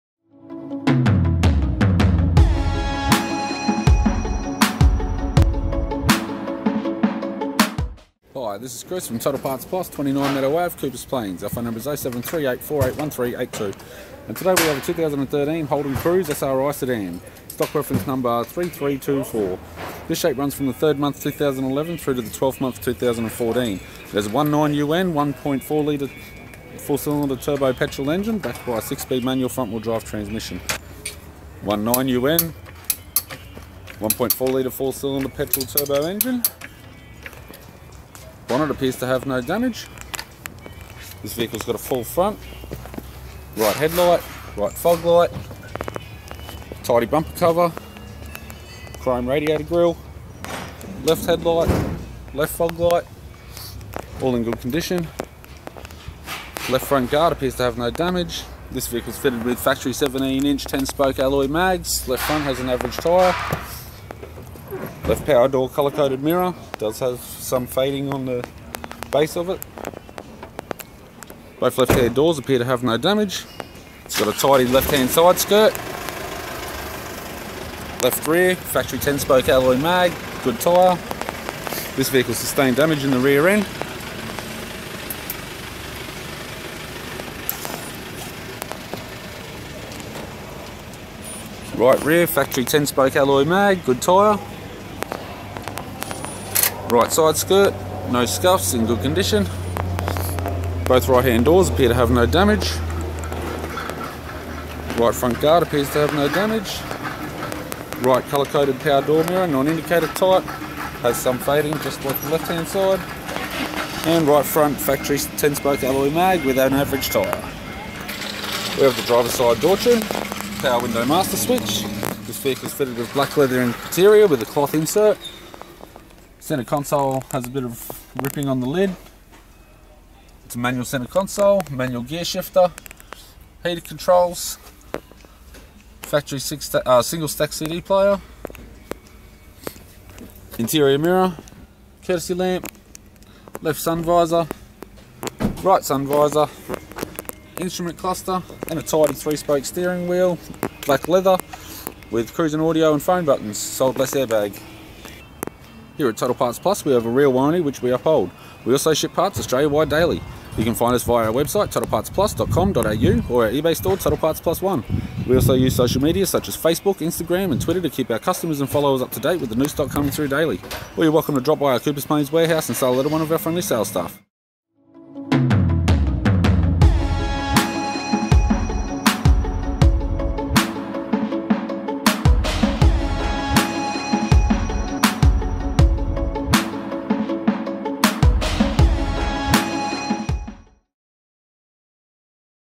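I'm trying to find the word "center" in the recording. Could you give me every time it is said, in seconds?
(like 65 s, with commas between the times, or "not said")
126 s, 130 s.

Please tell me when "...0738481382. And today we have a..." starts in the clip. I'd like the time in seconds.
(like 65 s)
11 s.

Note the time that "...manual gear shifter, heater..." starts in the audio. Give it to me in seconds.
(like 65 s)
131 s.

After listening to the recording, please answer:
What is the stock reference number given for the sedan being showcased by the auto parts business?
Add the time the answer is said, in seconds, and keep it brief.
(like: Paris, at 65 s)
3324, at 18 s.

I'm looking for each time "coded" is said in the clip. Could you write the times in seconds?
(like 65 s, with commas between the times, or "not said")
65 s, 108 s.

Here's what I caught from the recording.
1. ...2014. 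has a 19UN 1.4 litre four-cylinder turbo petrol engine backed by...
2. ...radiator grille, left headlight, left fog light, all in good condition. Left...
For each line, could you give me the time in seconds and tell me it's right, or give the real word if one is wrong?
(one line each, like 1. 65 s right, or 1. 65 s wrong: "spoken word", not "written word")
1. 22 s right
2. 49 s right.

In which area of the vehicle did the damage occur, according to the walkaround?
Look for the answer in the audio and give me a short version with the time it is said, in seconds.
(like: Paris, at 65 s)
Rear end, at 83 s.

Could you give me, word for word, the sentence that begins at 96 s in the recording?
Right side skirt, no scuffs, in good condition.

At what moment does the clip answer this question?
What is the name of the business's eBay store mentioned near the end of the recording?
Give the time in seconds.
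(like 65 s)
163 s.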